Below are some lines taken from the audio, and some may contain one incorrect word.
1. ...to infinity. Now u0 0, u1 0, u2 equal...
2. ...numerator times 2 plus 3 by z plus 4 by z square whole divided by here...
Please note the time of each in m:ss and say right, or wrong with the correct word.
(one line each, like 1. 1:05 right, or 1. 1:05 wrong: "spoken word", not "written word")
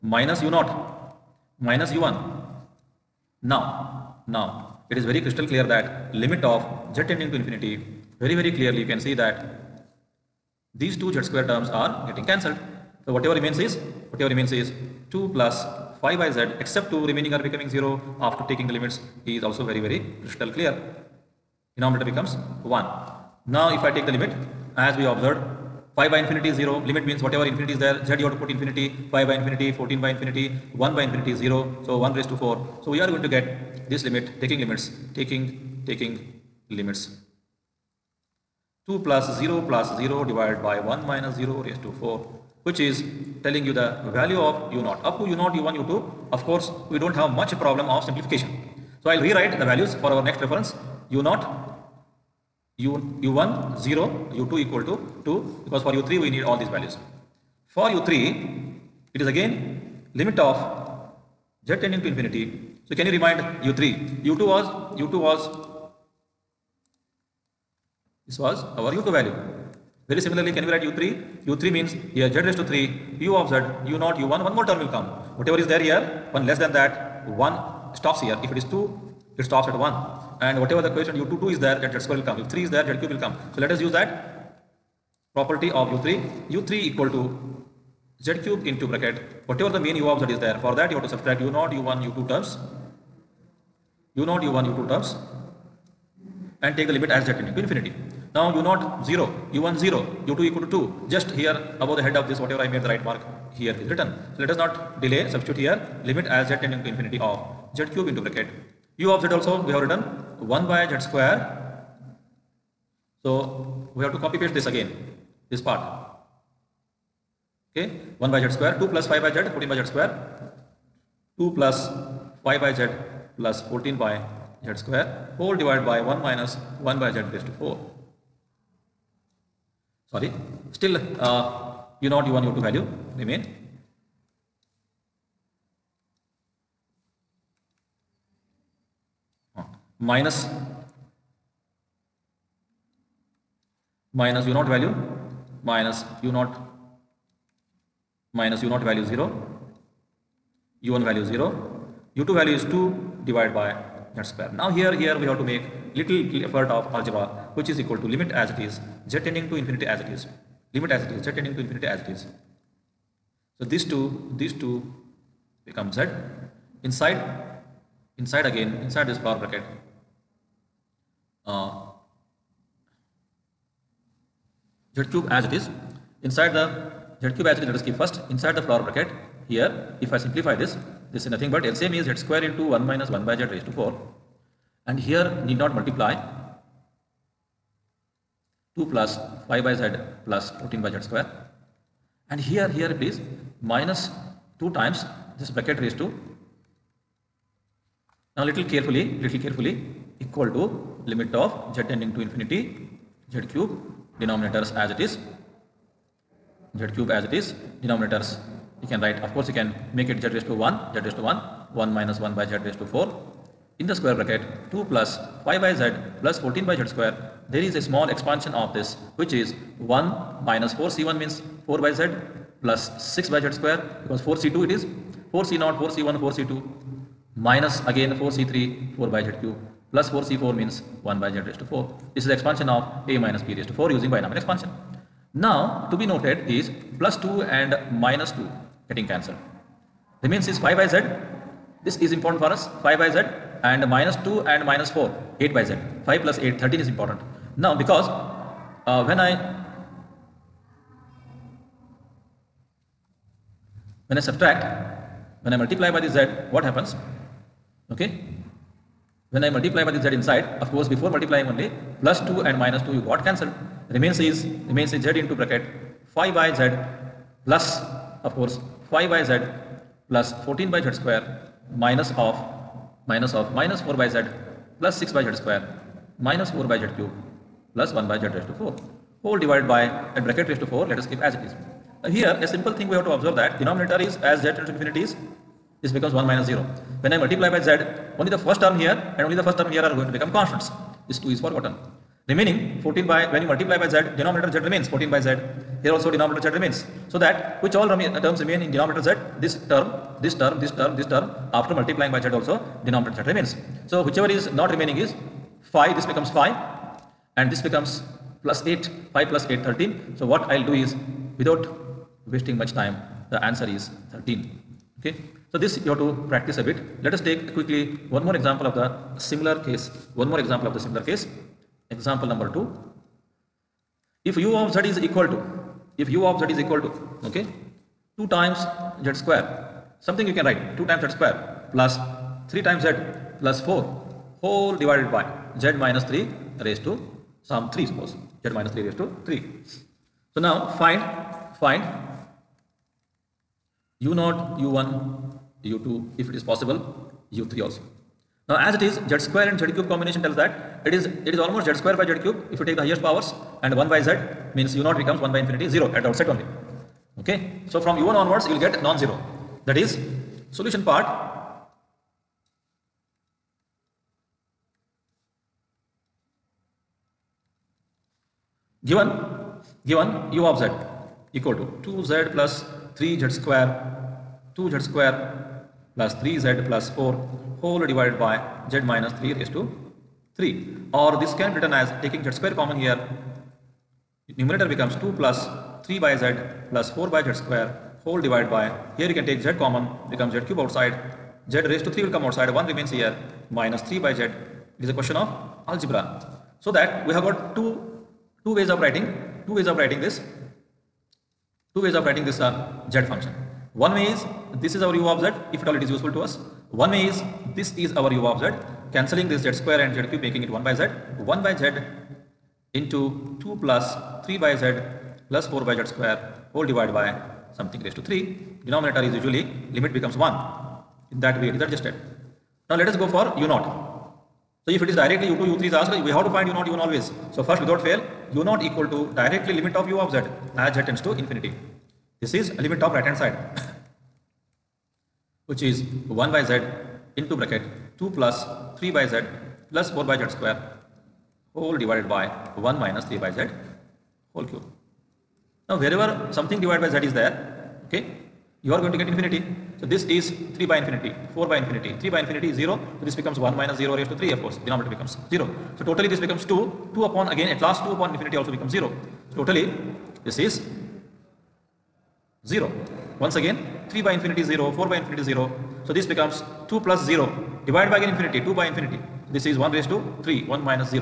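1. 1:37 right
2. 6:24 wrong: "becomes", not "times".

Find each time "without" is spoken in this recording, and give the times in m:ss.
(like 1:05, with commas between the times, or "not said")
5:11, 7:07.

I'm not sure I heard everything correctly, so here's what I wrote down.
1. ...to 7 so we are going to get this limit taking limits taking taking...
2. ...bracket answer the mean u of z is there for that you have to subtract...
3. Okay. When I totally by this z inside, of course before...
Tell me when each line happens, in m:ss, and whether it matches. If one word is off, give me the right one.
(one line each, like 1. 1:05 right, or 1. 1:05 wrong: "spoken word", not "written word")
1. 0:32 wrong: "4", not "7"
2. 1:28 wrong: "whatever", not "answer"
3. 4:17 wrong: "multiply", not "totally".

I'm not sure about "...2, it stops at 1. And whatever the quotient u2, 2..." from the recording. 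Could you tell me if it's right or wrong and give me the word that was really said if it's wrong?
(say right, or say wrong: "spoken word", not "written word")
right.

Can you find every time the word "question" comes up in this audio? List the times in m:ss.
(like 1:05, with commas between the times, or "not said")
6:34.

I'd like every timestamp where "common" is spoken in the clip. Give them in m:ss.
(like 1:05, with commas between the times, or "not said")
6:22, 6:29.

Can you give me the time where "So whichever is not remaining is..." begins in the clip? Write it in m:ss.
5:03.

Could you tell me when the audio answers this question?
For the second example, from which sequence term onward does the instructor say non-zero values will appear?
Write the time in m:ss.
5:57.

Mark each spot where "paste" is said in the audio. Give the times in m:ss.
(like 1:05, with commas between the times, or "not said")
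1:54.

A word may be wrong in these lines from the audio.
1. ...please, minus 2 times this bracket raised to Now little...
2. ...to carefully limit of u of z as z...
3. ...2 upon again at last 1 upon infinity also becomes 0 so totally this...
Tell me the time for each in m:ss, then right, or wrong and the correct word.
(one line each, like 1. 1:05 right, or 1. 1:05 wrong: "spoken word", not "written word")
1. 3:12 right
2. 7:08 wrong: "directly", not "carefully"
3. 7:36 wrong: "2", not "1".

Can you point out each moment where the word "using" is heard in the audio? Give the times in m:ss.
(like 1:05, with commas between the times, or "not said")
3:53.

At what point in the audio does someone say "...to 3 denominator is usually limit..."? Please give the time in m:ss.
6:57.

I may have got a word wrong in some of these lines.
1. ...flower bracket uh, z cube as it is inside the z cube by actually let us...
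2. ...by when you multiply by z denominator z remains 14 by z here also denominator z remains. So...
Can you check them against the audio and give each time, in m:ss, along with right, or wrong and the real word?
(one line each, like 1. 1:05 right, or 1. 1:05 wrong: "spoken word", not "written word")
1. 2:49 right
2. 4:53 right.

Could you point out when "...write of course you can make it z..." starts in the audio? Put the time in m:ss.
3:29.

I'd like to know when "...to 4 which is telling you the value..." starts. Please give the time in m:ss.
0:41.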